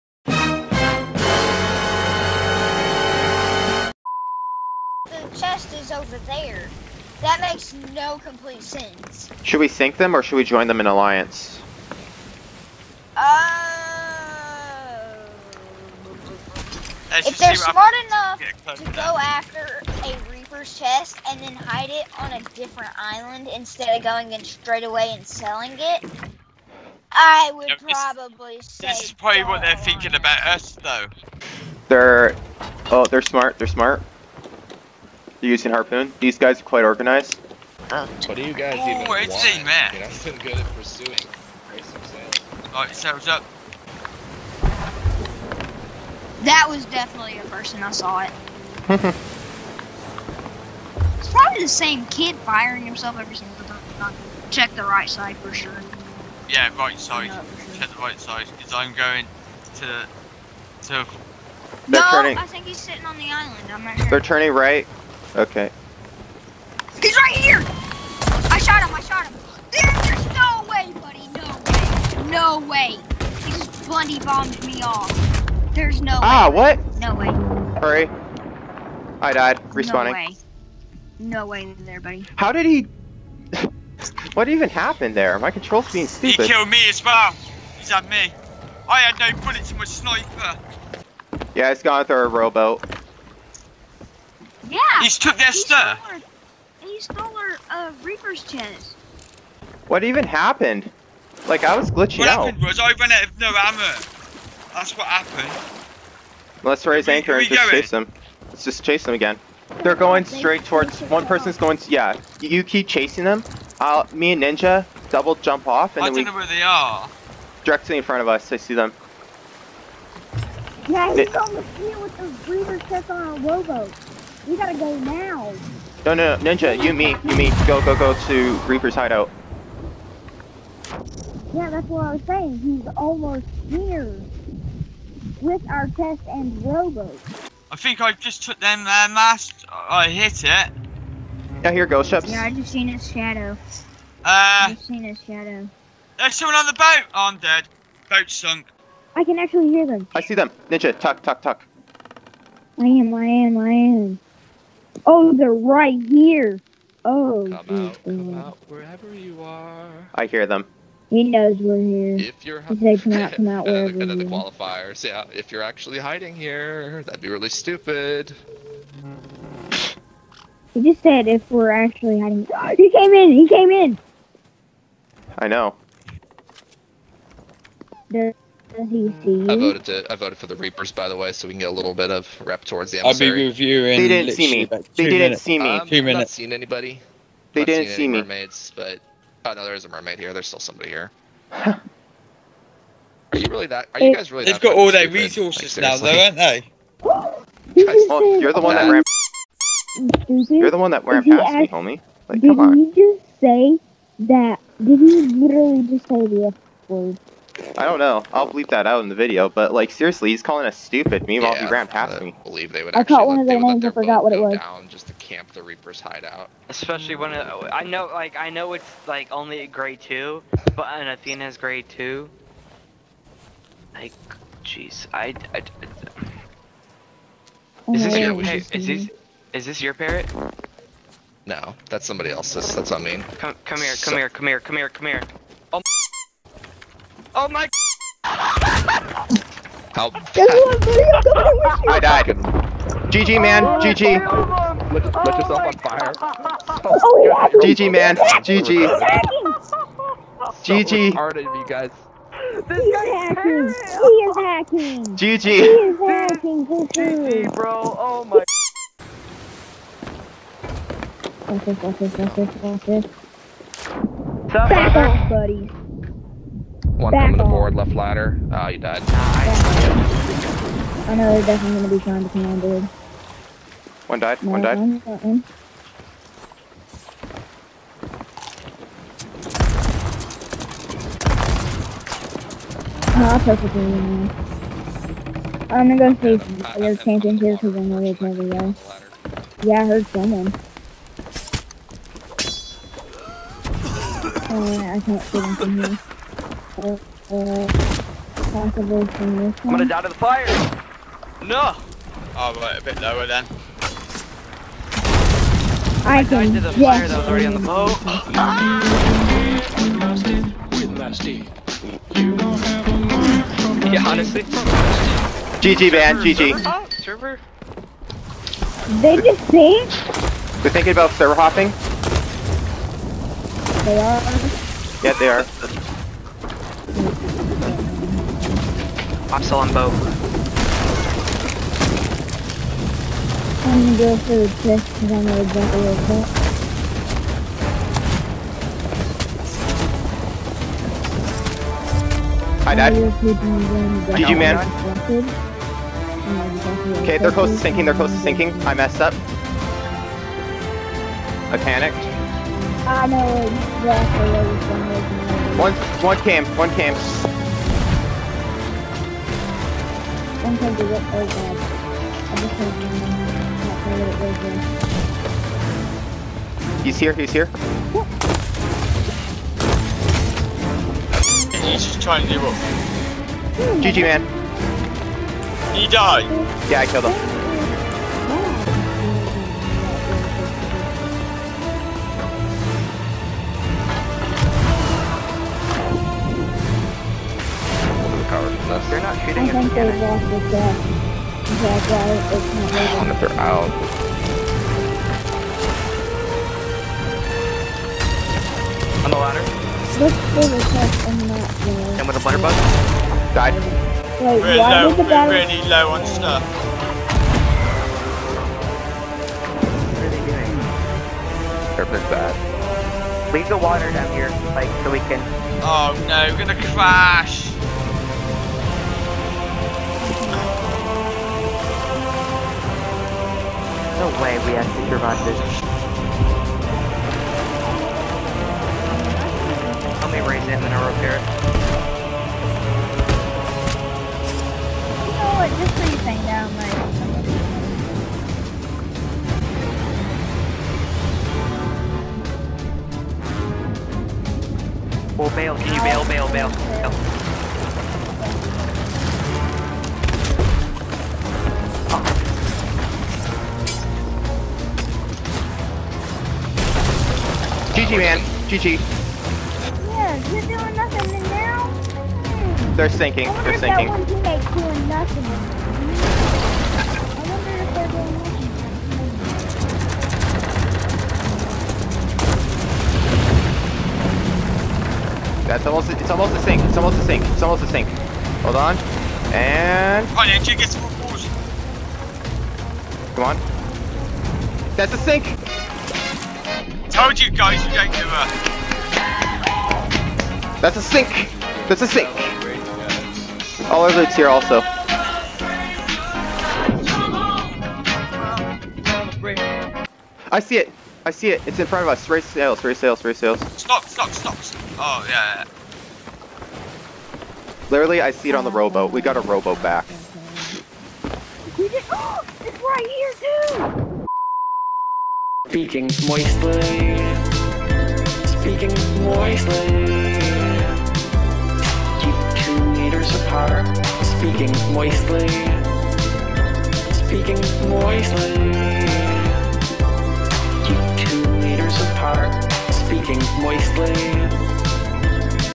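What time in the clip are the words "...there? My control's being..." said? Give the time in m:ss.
1:25.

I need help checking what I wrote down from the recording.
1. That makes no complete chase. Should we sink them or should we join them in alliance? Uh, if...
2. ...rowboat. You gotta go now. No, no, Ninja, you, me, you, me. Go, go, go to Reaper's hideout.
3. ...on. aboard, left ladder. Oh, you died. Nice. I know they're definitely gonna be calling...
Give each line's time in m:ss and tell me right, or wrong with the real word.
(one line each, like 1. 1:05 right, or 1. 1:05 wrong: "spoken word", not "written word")
1. 0:07 wrong: "sense", not "chase"
2. 2:03 right
3. 4:27 wrong: "trying", not "calling".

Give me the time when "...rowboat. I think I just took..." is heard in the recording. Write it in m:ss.
2:16.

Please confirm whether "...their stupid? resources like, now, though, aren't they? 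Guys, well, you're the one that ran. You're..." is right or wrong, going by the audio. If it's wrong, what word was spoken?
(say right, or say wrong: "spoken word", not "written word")
right.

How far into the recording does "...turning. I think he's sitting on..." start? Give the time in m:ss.
1:02.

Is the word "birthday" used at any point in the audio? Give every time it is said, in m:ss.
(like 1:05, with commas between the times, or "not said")
not said.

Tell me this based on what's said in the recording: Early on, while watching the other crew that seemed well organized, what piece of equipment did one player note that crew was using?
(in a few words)
harpoon.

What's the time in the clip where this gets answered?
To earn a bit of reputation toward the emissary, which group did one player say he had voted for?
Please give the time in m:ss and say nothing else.
3:00.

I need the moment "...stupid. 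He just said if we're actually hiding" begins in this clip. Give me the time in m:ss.
2:47.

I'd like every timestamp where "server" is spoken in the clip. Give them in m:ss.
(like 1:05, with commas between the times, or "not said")
5:16, 5:21.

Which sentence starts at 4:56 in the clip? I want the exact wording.
I'm gonna die to the fire!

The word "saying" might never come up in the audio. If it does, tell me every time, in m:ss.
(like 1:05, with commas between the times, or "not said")
2:12.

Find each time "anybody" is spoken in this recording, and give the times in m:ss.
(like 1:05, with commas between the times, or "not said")
3:06.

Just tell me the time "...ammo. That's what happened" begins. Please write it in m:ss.
1:43.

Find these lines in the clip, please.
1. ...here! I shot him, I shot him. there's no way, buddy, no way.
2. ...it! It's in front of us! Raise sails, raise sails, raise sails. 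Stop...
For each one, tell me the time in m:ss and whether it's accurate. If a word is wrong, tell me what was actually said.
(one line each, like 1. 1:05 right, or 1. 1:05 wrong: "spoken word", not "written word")
1. 1:07 right
2. 8:21 right.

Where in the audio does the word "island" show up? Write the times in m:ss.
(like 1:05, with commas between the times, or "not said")
0:22, 1:03.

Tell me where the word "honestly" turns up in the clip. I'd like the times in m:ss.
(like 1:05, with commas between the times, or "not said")
5:14.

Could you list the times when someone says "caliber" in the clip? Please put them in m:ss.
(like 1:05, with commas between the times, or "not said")
not said.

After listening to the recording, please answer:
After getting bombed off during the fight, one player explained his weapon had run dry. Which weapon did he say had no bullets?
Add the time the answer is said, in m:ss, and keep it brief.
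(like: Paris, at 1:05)
sniper, at 1:29.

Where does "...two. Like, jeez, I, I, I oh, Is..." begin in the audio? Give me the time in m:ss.
3:41.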